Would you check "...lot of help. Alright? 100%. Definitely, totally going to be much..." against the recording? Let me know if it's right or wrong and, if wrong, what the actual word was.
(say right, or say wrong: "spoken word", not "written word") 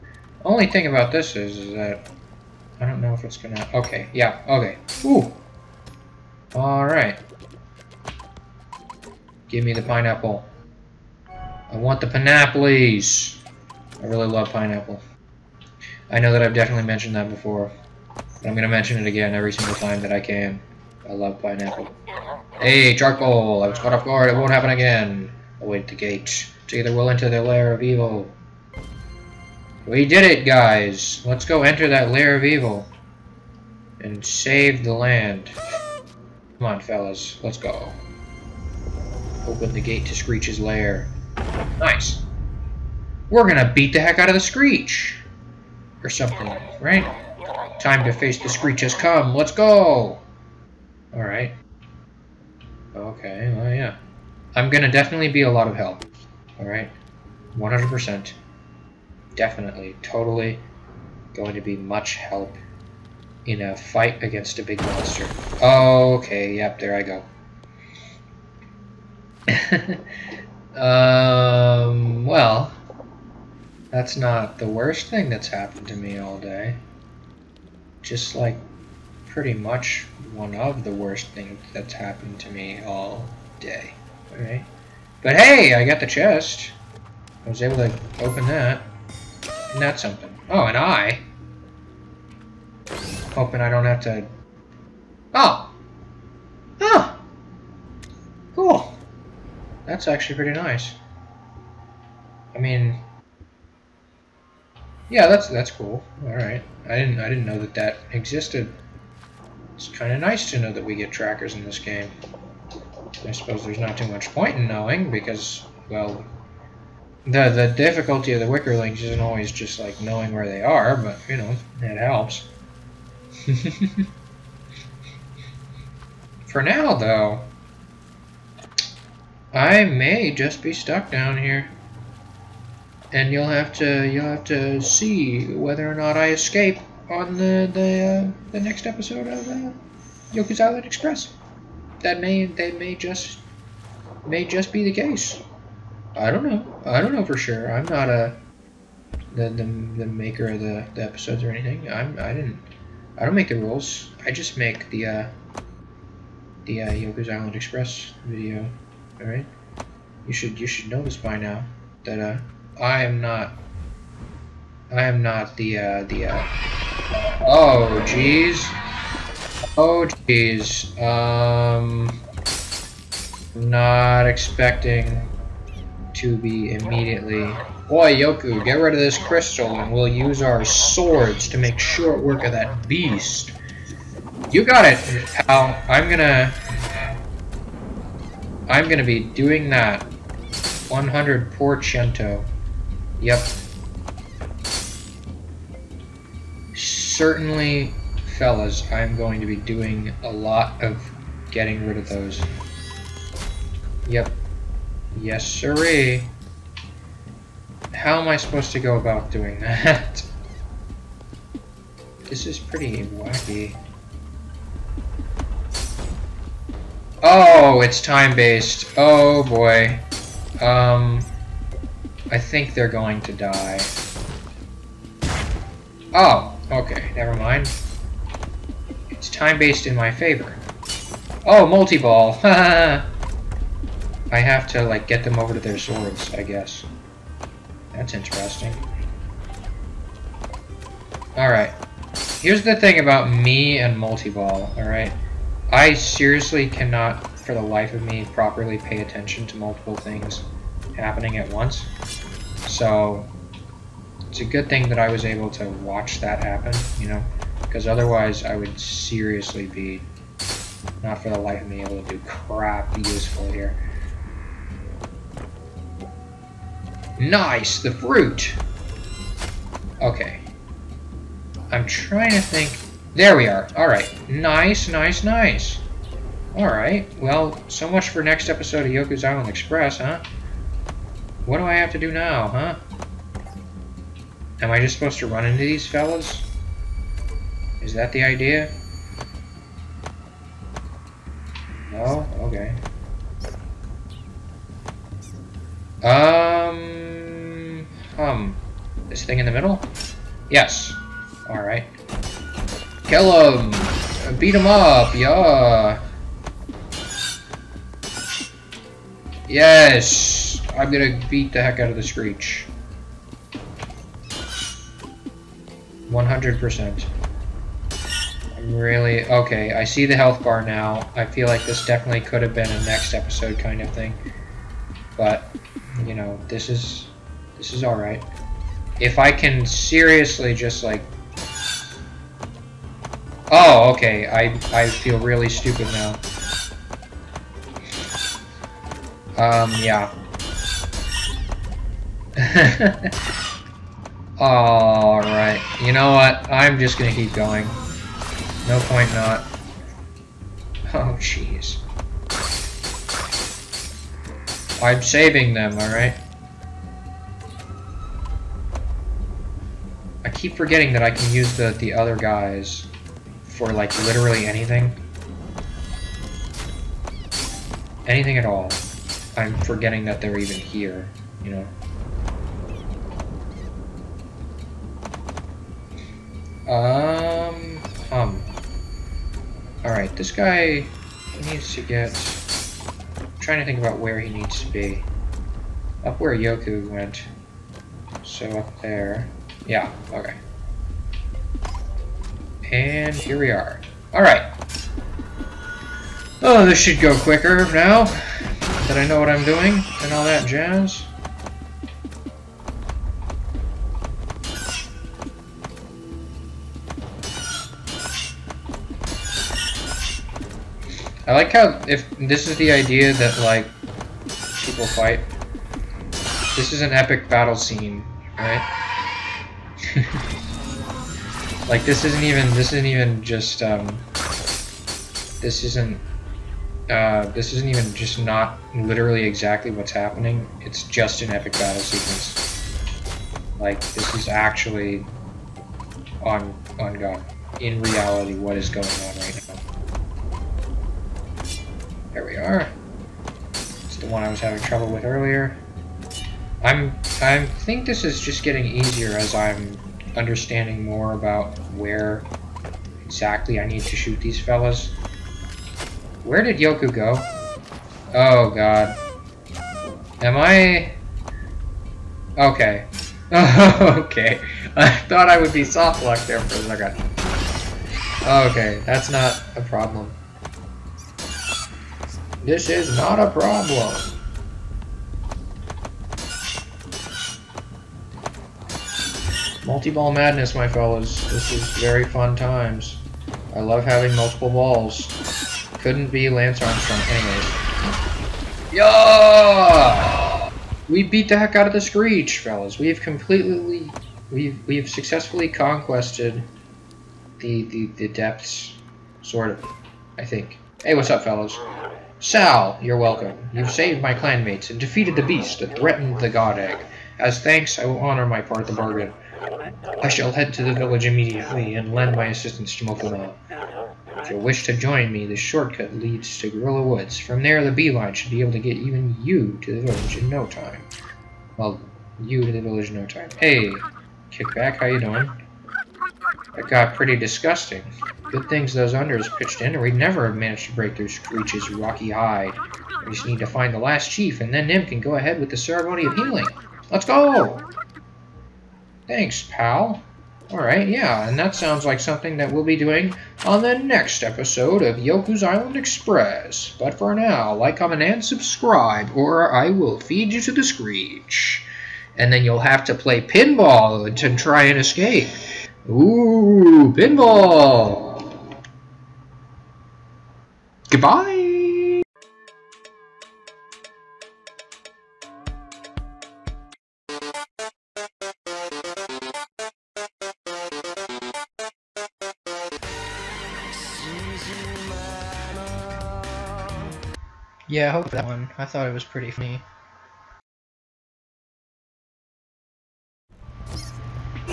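right.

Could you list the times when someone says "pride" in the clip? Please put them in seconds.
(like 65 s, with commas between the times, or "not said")
not said.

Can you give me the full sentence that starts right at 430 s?
It's just an epic battle sequence.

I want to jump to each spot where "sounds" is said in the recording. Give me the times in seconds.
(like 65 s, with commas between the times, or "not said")
541 s.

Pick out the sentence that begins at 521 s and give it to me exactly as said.
Well, you to the village in no time.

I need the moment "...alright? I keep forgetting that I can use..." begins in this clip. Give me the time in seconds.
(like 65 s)
355 s.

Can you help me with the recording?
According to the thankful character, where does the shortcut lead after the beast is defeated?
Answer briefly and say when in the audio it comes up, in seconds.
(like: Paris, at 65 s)
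Gorilla Woods, at 515 s.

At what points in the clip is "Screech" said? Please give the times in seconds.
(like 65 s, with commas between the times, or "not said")
40 s, 44 s, 48 s, 312 s, 491 s, 531 s, 550 s.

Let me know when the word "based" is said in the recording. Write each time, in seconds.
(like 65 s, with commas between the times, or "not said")
218 s, 229 s.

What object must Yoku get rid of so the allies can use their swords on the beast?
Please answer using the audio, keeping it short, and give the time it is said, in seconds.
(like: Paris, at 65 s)
Crystal, at 178 s.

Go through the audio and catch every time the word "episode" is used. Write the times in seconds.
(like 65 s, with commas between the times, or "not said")
138 s, 151 s, 278 s, 323 s, 544 s.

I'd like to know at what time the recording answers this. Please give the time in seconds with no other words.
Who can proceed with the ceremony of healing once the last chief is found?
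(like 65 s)
534 s.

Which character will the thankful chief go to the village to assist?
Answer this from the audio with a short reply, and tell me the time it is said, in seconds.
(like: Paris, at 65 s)
Mokuma, at 511 s.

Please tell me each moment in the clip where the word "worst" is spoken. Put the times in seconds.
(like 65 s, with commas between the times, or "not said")
74 s, 80 s.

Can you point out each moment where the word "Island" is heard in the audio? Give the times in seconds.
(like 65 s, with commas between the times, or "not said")
140 s, 157 s, 279 s, 545 s.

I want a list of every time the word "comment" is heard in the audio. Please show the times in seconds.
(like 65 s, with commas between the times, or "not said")
547 s.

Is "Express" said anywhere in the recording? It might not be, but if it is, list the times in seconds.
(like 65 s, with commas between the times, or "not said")
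140 s, 157 s, 279 s, 545 s.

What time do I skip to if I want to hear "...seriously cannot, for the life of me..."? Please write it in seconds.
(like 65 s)
245 s.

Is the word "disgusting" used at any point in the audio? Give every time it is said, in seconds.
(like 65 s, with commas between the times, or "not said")
527 s.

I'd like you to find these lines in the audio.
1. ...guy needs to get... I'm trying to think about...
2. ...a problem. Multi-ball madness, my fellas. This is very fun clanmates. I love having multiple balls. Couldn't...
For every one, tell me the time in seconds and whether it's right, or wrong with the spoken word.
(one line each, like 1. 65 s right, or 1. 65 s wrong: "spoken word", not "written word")
1. 380 s right
2. 473 s wrong: "times", not "clanmates".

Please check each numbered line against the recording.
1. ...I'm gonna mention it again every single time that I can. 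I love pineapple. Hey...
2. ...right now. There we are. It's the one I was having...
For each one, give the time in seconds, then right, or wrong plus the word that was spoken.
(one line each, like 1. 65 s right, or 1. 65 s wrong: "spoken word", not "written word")
1. 18 s right
2. 439 s right.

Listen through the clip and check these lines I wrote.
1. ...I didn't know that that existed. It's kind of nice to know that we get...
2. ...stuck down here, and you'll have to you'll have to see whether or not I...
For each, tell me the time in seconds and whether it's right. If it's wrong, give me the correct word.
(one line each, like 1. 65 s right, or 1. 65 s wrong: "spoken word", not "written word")
1. 107 s right
2. 130 s right.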